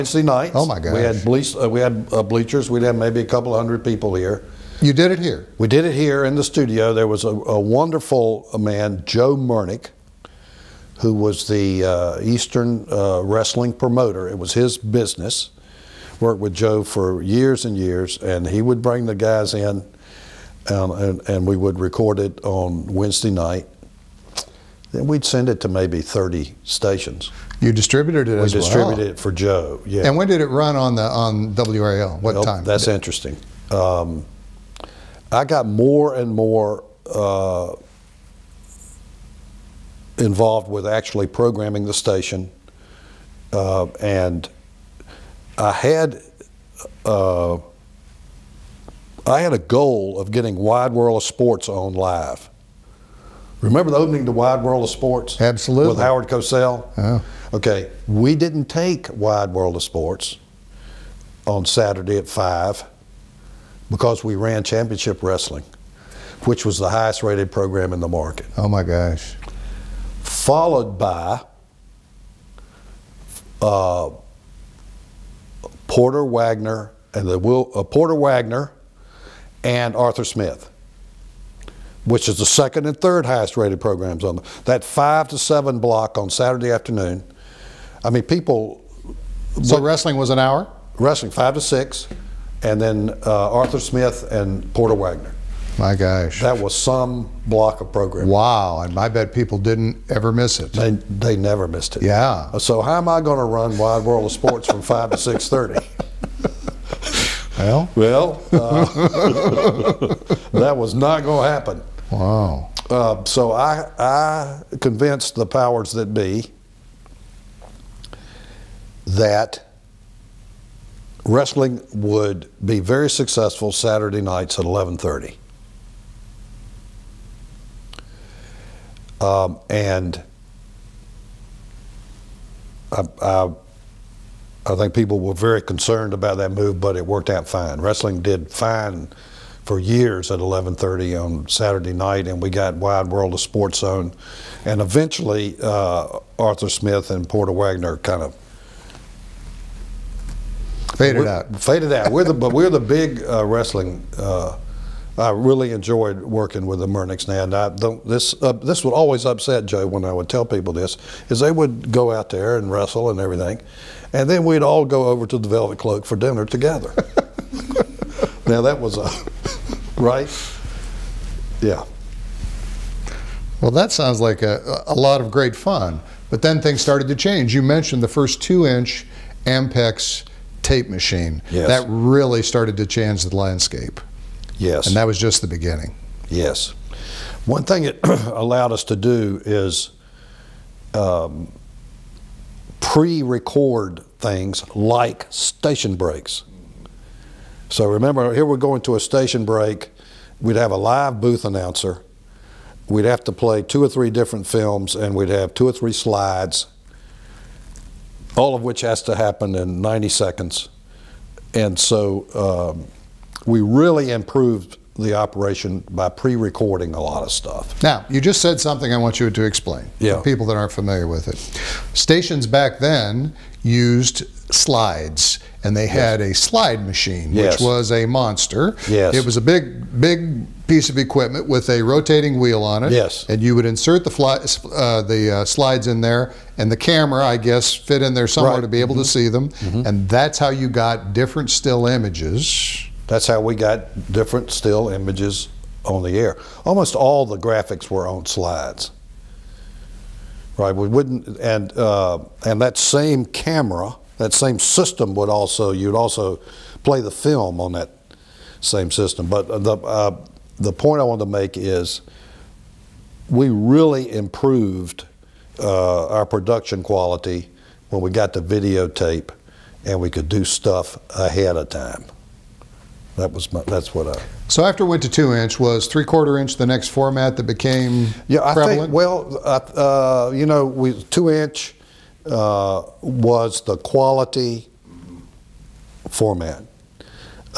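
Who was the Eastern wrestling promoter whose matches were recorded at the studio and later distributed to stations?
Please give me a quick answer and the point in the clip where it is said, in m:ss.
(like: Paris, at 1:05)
Joe Murnick, at 0:09.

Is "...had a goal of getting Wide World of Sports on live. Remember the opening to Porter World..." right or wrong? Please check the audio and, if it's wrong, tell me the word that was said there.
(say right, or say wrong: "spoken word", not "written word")
wrong: "Wide", not "Porter".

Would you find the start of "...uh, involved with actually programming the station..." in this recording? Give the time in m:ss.
0:37.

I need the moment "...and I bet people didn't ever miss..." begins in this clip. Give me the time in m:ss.
1:38.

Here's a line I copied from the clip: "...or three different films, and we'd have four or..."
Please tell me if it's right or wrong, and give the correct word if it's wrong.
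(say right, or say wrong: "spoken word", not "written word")
wrong: "two", not "four".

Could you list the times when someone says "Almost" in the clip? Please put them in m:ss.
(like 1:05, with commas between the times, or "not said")
4:06.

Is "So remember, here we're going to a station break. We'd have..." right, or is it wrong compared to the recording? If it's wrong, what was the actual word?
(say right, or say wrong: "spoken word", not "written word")
right.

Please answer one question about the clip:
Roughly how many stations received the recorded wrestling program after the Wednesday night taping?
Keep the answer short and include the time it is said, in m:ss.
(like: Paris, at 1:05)
30, at 0:26.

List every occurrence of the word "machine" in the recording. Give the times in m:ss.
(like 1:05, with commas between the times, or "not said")
3:00, 3:46.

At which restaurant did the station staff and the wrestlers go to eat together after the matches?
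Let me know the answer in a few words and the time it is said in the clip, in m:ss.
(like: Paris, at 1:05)
Velvet Cloak, at 2:45.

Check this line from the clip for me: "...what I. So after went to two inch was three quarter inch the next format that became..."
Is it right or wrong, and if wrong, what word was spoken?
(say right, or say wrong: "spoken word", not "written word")
right.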